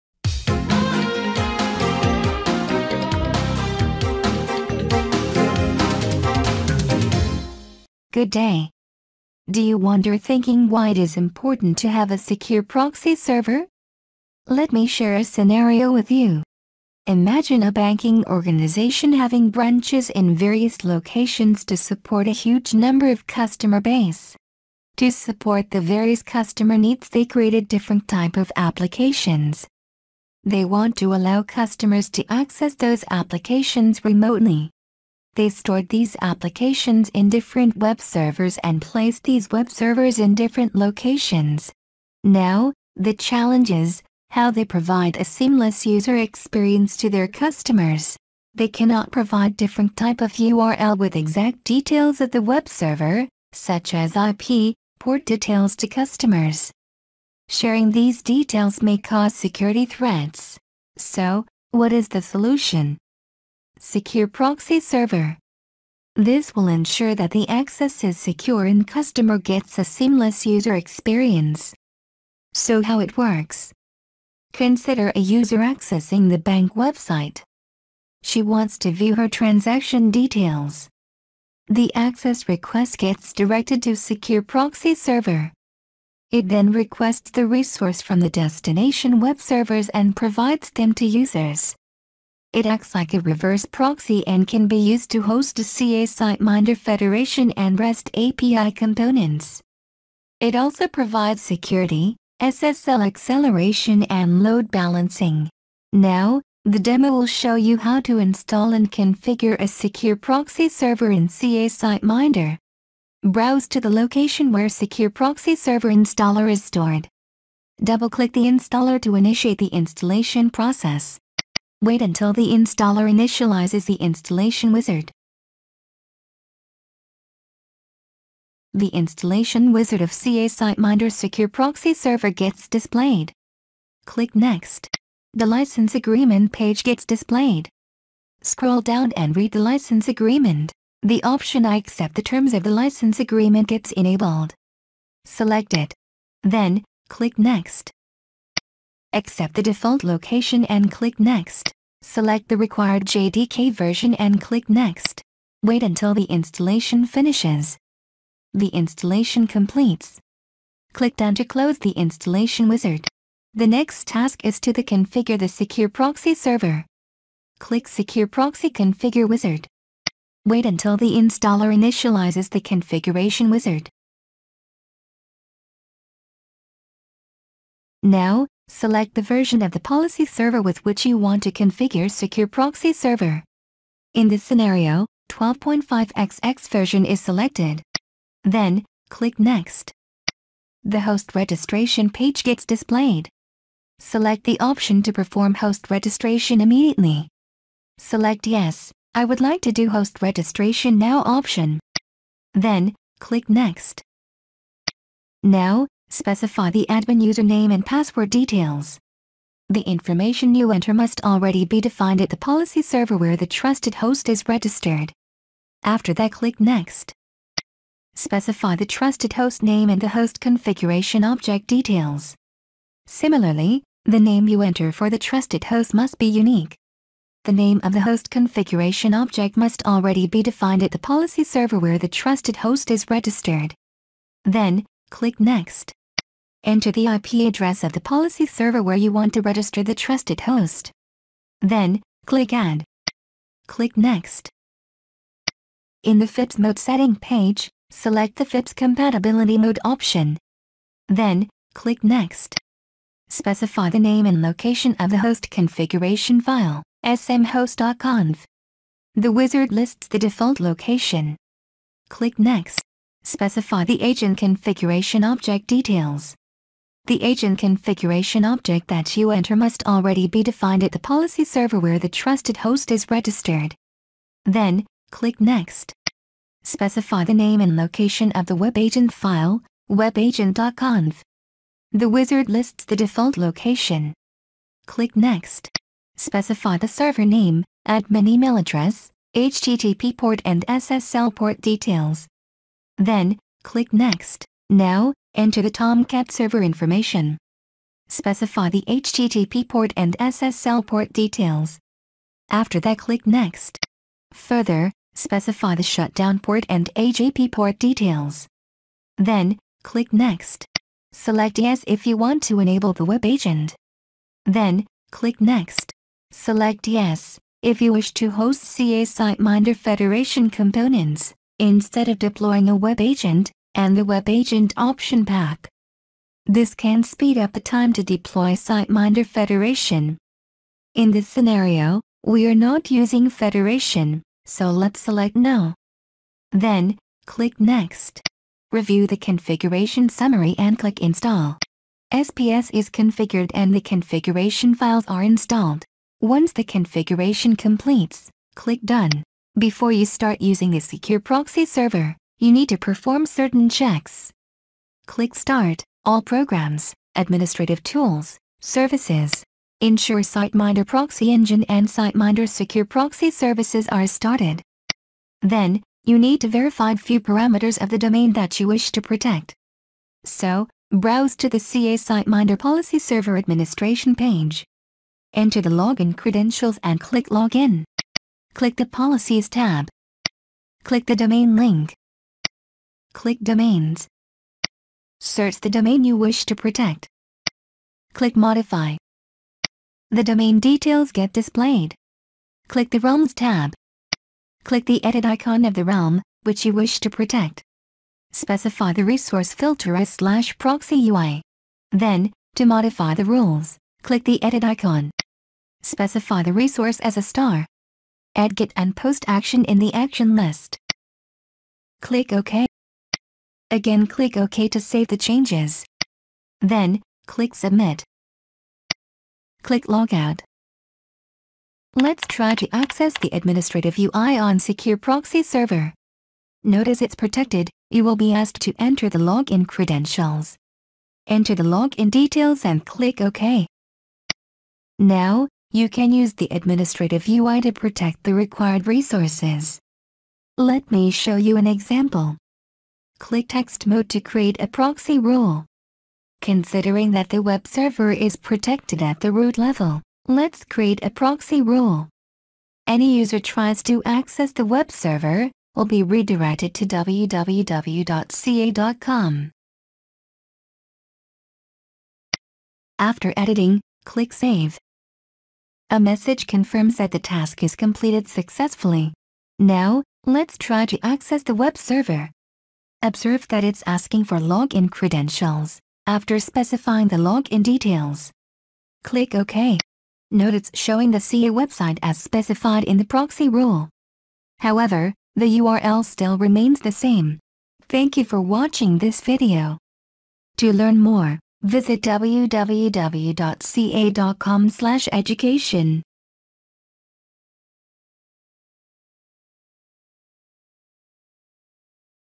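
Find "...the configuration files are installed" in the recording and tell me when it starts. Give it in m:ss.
5:43.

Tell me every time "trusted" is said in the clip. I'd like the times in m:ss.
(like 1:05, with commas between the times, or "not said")
3:33, 3:38, 3:45, 3:52, 3:59, 4:32.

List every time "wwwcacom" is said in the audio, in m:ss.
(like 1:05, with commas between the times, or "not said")
7:36, 8:12.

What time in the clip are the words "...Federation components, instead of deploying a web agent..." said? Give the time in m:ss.
5:19.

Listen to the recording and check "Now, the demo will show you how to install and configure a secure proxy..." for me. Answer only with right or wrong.
right.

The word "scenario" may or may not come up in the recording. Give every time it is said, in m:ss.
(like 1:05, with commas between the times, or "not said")
0:15, 3:04, 5:31.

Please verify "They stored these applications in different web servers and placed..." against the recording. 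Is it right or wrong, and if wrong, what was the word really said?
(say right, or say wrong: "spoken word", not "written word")
right.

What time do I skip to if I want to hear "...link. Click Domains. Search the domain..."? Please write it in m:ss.
6:21.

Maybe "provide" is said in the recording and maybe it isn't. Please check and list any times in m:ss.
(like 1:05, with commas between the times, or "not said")
0:44, 0:49, 1:30, 1:40.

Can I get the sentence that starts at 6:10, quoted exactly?
So, browse to the CA SiteMinder Policy Server Administration page.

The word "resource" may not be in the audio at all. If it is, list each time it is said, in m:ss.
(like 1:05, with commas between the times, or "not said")
1:27, 6:39, 6:46, 7:18.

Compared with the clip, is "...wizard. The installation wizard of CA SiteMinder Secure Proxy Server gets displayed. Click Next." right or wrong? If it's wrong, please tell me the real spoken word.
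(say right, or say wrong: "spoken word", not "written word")
right.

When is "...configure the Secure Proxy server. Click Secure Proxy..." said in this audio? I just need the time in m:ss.
2:44.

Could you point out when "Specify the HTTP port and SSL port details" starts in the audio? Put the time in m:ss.
4:58.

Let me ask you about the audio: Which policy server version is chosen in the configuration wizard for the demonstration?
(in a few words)
12.5xx.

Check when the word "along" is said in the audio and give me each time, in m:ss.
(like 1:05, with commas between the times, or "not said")
not said.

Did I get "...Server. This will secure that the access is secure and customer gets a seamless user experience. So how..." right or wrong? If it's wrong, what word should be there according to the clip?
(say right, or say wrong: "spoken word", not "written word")
wrong: "ensure", not "secure".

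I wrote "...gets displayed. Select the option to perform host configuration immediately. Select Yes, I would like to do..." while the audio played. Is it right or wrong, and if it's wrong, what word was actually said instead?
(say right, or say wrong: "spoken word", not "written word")
wrong: "registration", not "configuration".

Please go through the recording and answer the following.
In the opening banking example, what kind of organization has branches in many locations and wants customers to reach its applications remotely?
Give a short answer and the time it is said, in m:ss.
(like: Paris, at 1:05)
Banking organization, at 0:17.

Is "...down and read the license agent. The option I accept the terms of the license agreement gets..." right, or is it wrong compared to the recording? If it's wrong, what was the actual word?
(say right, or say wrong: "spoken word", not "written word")
wrong: "agreement", not "agent".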